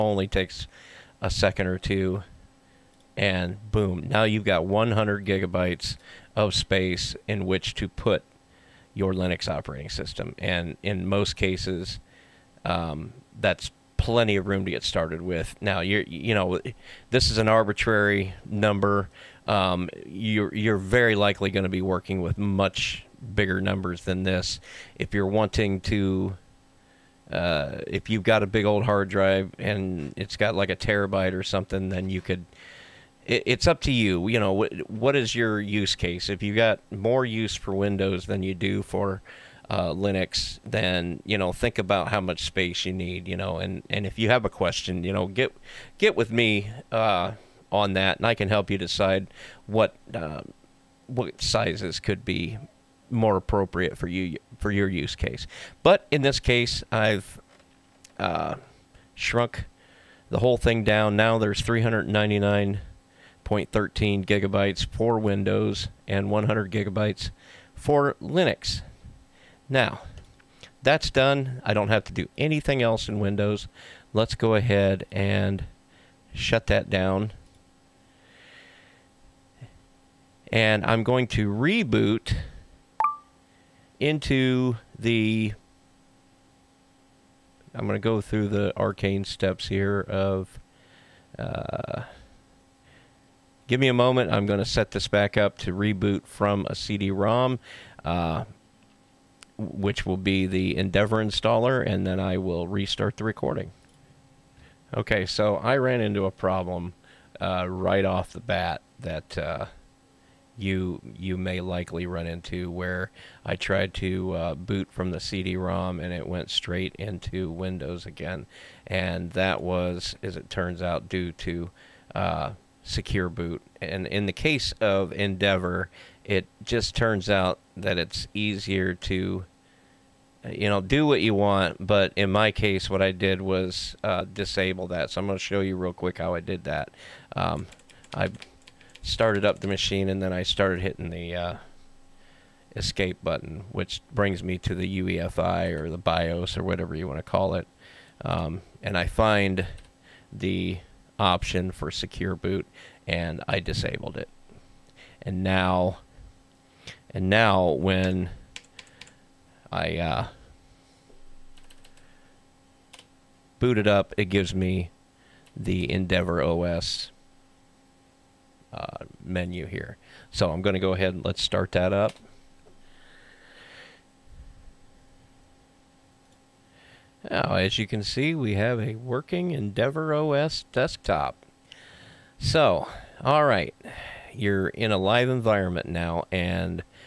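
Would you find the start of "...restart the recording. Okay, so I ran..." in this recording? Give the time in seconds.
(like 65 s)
102 s.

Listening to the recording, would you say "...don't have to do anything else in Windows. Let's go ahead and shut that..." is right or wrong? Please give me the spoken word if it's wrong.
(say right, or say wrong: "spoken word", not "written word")
right.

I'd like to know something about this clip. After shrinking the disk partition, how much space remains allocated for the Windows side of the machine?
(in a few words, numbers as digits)
399.13 gigabytes.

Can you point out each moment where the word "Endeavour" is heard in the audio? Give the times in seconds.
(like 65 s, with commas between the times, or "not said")
100 s, 125 s, 165 s, 179 s.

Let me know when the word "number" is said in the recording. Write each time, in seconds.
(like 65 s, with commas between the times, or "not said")
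18 s, 23 s.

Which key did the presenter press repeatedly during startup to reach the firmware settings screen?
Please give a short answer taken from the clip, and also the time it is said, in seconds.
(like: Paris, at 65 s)
Escape, at 142 s.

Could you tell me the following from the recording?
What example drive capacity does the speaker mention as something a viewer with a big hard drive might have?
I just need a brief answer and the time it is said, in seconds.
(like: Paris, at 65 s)
1 terabyte, at 30 s.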